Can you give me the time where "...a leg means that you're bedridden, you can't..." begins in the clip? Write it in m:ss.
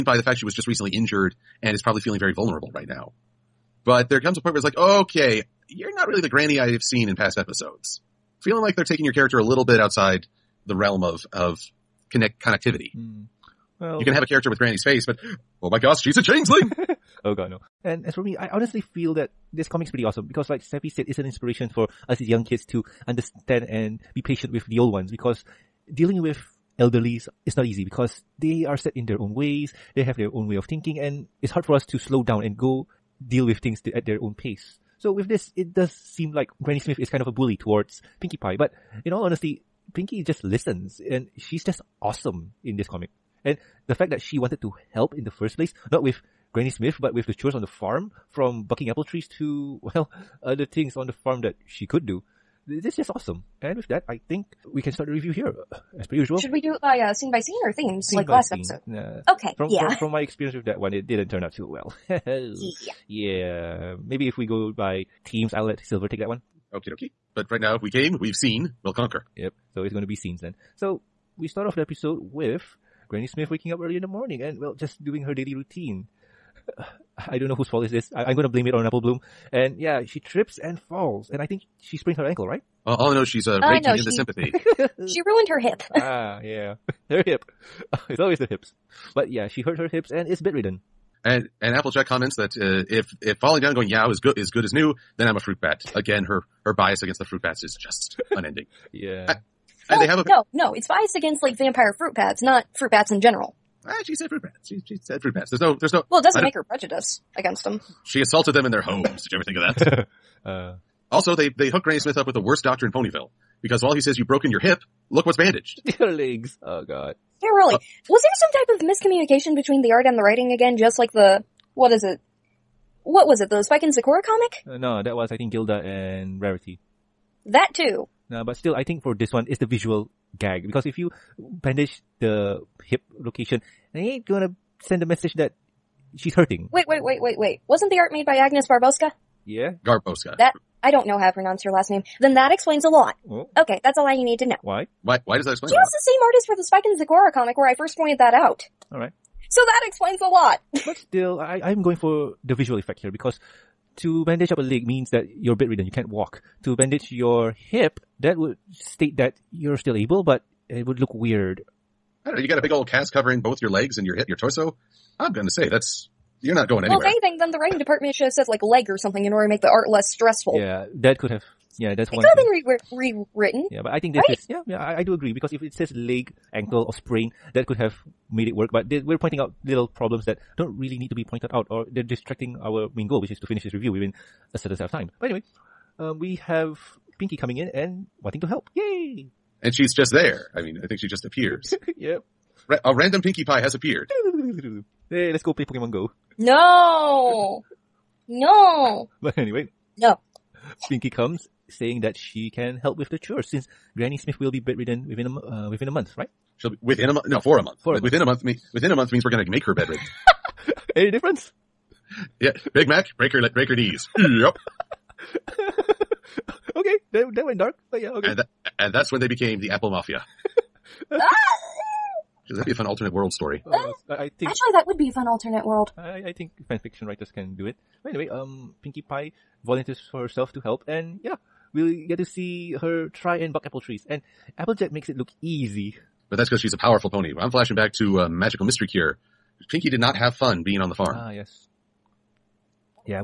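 2:34.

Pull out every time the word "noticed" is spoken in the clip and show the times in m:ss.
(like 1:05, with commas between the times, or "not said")
not said.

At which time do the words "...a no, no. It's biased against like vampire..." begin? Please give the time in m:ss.
1:40.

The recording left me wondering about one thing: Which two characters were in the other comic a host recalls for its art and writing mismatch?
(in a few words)
Gilda and Rarity.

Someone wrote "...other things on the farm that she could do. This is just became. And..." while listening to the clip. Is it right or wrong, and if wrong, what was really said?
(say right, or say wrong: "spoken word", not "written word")
wrong: "awesome", not "became".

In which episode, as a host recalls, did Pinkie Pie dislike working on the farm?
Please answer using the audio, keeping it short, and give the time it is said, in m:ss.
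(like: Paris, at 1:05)
Magical Mystery Cure, at 3:58.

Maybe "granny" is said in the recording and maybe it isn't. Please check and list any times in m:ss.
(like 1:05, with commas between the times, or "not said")
0:06, 0:14, 0:36, 0:46, 1:13, 1:51, 3:23.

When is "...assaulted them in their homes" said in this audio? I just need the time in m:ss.
1:48.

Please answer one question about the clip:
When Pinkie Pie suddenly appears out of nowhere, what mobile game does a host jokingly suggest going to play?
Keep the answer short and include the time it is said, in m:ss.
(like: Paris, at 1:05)
Pokemon Go, at 3:15.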